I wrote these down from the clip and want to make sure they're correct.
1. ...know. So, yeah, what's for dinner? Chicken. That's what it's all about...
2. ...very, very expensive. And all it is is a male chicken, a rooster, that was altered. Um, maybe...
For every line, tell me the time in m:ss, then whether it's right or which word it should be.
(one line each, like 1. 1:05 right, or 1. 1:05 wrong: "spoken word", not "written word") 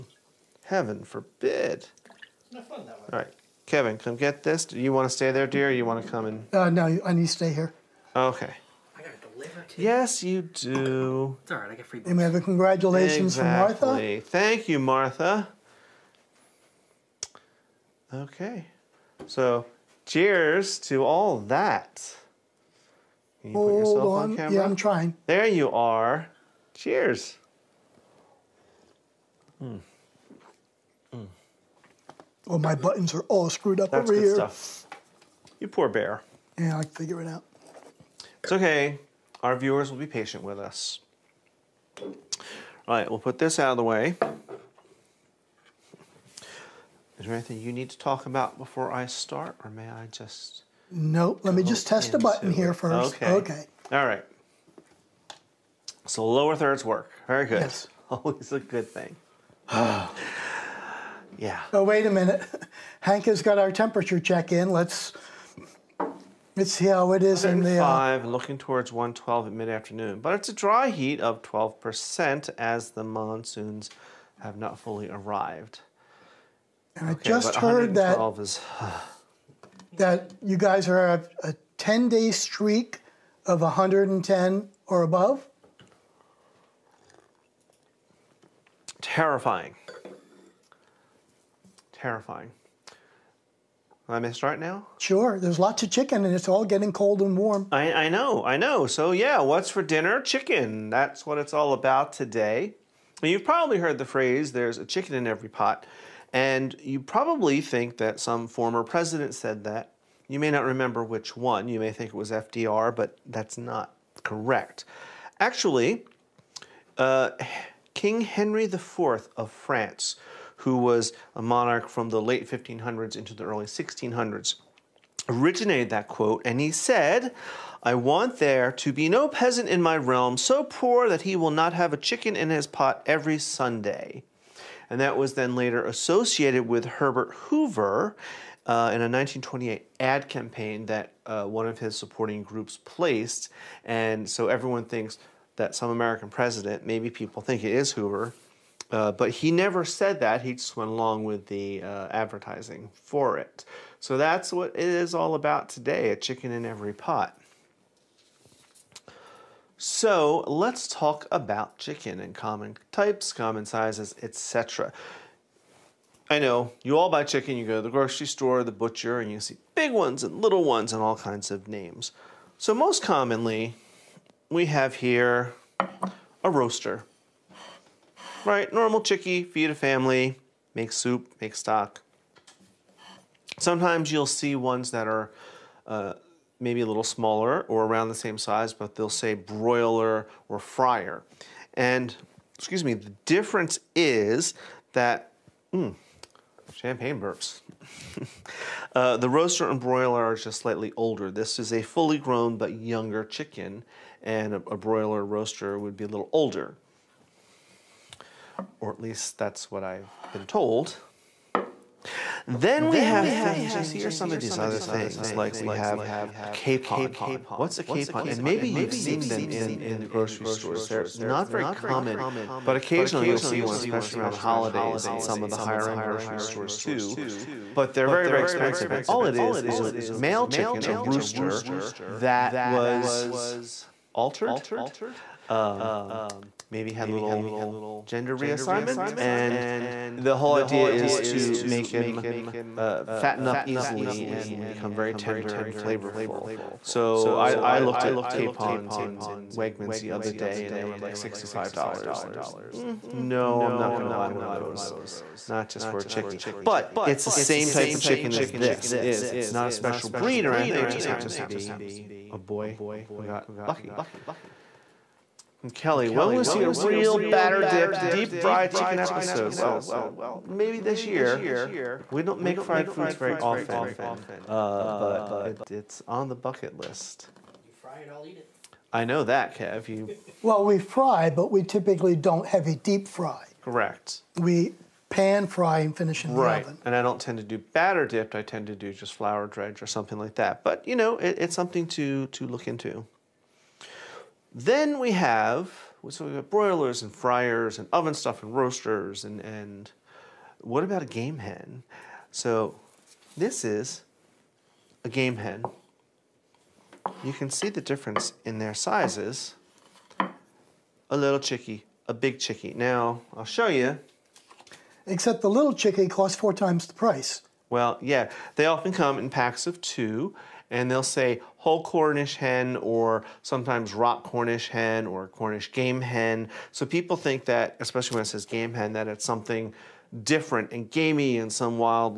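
1. 1:38 right
2. 3:48 right.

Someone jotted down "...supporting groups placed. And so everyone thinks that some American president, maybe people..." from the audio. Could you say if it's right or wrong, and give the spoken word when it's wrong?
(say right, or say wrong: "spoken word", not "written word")
right.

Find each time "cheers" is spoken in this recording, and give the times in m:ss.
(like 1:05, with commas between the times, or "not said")
0:20, 0:26.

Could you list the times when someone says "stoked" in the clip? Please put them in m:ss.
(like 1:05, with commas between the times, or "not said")
not said.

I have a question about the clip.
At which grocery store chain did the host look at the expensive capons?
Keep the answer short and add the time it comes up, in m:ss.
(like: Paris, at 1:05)
Wegmans, at 4:09.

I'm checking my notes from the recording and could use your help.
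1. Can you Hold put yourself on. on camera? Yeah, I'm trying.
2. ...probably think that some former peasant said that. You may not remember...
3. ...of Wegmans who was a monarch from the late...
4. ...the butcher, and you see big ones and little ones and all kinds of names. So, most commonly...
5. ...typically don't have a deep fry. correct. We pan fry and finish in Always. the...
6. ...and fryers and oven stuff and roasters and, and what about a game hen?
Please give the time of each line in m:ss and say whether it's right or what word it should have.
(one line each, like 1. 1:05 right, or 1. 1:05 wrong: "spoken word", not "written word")
1. 0:23 right
2. 1:47 wrong: "president", not "peasant"
3. 1:59 wrong: "France", not "Wegmans"
4. 2:48 right
5. 4:41 wrong: "Right", not "Always"
6. 4:57 right.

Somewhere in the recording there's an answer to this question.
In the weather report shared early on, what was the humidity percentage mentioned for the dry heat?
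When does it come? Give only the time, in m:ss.
1:11.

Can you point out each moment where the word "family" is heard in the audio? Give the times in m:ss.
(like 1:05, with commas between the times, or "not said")
2:59.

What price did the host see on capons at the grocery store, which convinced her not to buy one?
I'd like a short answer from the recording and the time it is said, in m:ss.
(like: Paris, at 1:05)
$65, at 4:11.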